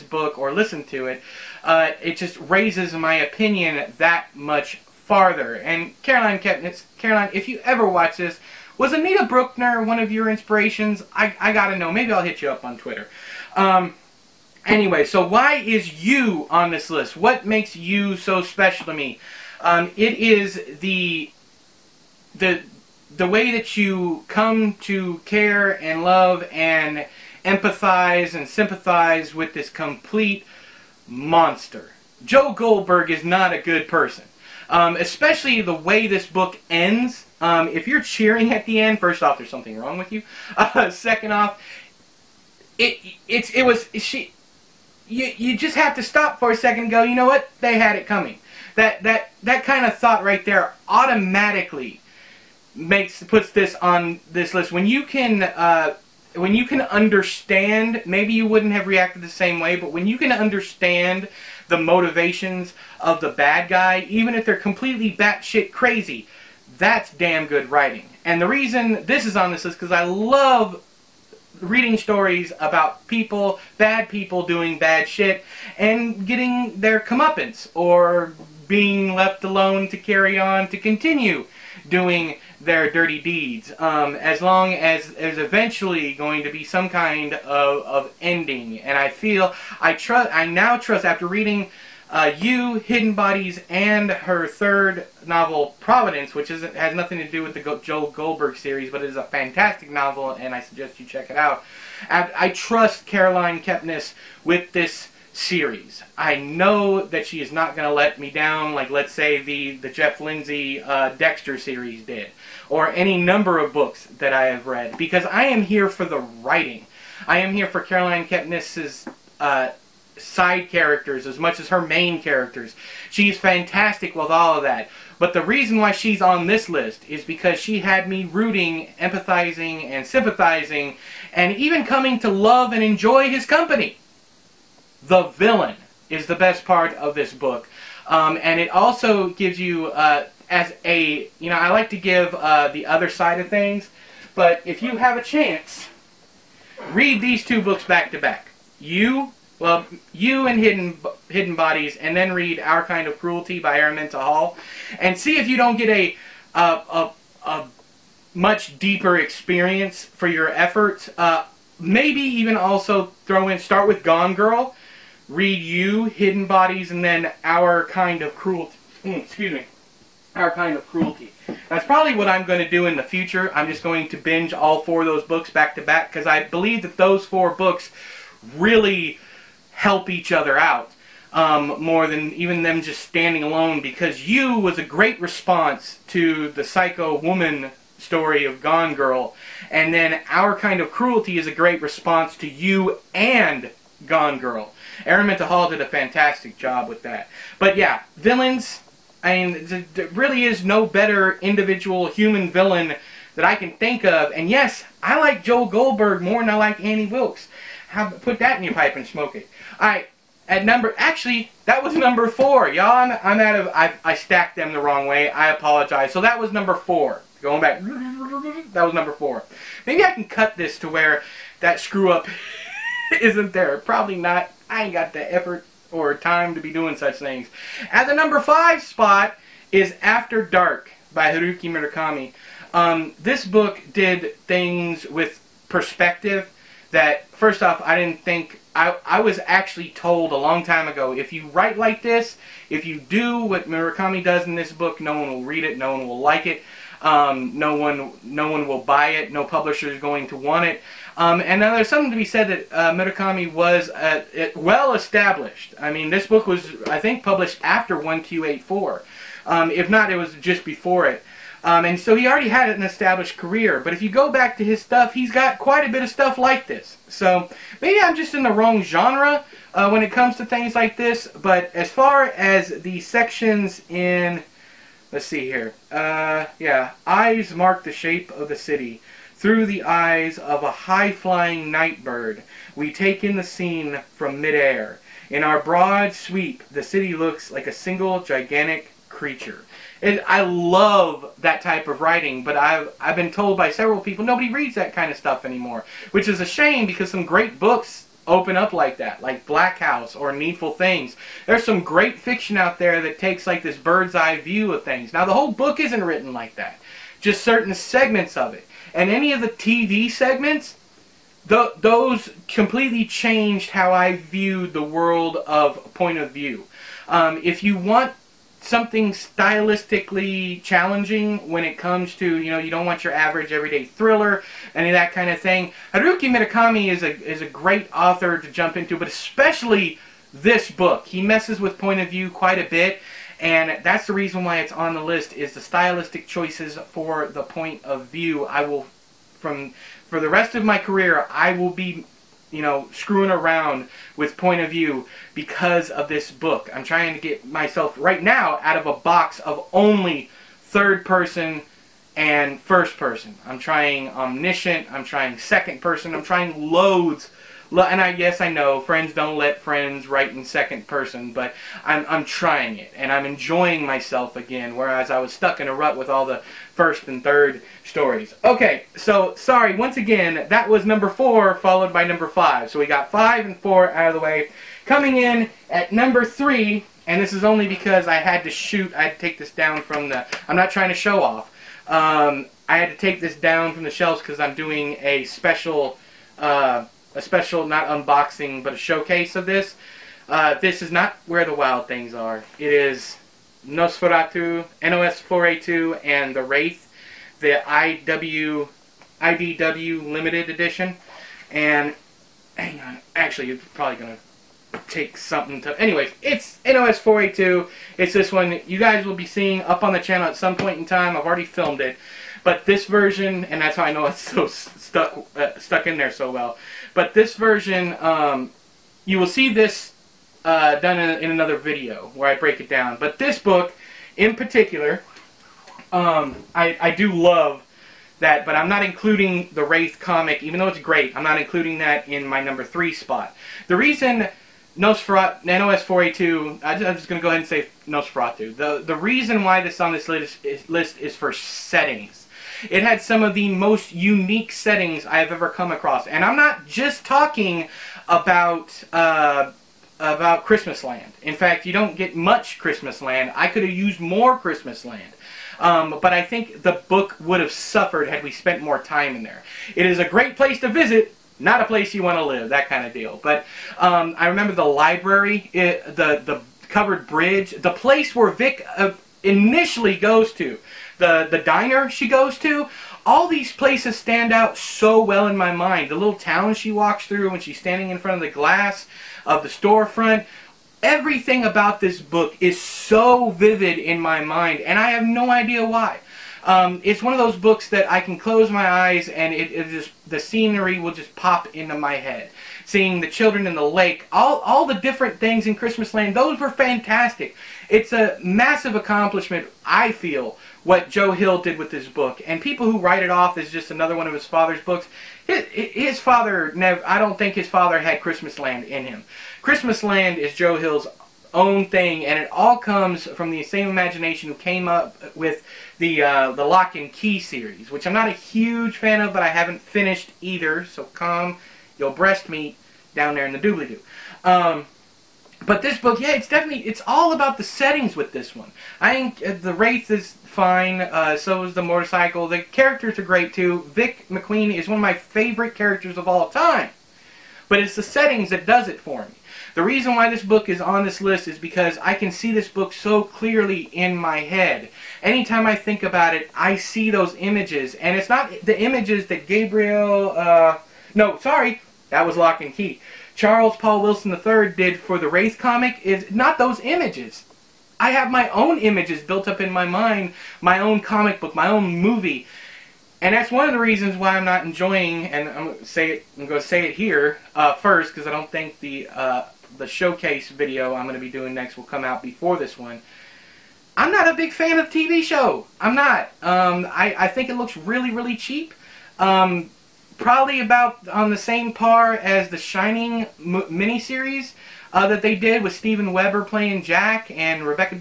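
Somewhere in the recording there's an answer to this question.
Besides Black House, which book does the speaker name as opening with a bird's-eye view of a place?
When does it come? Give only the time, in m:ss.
5:00.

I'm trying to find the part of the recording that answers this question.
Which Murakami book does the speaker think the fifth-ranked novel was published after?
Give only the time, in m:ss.
4:17.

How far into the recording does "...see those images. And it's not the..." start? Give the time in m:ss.
9:06.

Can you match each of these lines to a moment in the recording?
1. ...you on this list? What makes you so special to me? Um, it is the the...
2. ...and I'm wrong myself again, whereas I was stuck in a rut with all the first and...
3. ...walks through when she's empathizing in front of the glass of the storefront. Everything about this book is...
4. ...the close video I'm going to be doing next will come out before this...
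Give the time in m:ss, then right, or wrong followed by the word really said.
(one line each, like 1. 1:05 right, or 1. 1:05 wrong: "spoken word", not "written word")
1. 0:16 right
2. 6:02 wrong: "enjoying", not "wrong"
3. 7:56 wrong: "standing", not "empathizing"
4. 9:29 wrong: "showcase", not "close".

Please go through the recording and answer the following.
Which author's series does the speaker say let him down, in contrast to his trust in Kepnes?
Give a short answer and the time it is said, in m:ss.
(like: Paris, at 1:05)
Jeff Lindsay, at 1:49.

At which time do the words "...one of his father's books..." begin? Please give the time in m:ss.
8:23.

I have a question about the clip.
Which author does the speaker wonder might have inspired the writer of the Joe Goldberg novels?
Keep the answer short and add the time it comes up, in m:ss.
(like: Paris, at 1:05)
Anita Brookner, at 0:08.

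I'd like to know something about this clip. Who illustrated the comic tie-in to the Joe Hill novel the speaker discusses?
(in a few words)
Charles Paul Wilson III.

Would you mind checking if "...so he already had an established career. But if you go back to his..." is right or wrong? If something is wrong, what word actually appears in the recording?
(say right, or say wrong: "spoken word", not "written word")
right.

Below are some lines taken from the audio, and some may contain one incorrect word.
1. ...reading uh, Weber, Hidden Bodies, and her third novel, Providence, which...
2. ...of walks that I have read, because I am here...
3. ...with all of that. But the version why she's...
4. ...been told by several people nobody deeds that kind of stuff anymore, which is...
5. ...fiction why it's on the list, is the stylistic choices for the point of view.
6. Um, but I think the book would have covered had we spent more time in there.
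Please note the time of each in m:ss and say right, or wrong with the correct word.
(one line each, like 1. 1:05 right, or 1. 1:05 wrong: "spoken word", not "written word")
1. 1:31 wrong: "You", not "Weber"
2. 1:53 wrong: "books", not "walks"
3. 2:04 wrong: "reason", not "version"
4. 4:53 wrong: "reads", not "deeds"
5. 5:34 wrong: "reason", not "fiction"
6. 7:35 wrong: "suffered", not "covered".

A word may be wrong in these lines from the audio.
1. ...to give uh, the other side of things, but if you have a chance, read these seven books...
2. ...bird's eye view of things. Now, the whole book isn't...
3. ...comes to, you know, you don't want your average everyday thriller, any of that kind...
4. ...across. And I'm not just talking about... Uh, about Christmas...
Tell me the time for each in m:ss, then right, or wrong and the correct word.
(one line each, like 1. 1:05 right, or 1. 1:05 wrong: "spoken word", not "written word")
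1. 2:21 wrong: "two", not "seven"
2. 5:03 right
3. 5:21 right
4. 7:25 right.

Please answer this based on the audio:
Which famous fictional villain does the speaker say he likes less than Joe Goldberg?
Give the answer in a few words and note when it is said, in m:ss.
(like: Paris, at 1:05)
Annie Wilkes, at 3:26.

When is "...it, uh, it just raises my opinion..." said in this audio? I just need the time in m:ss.
0:01.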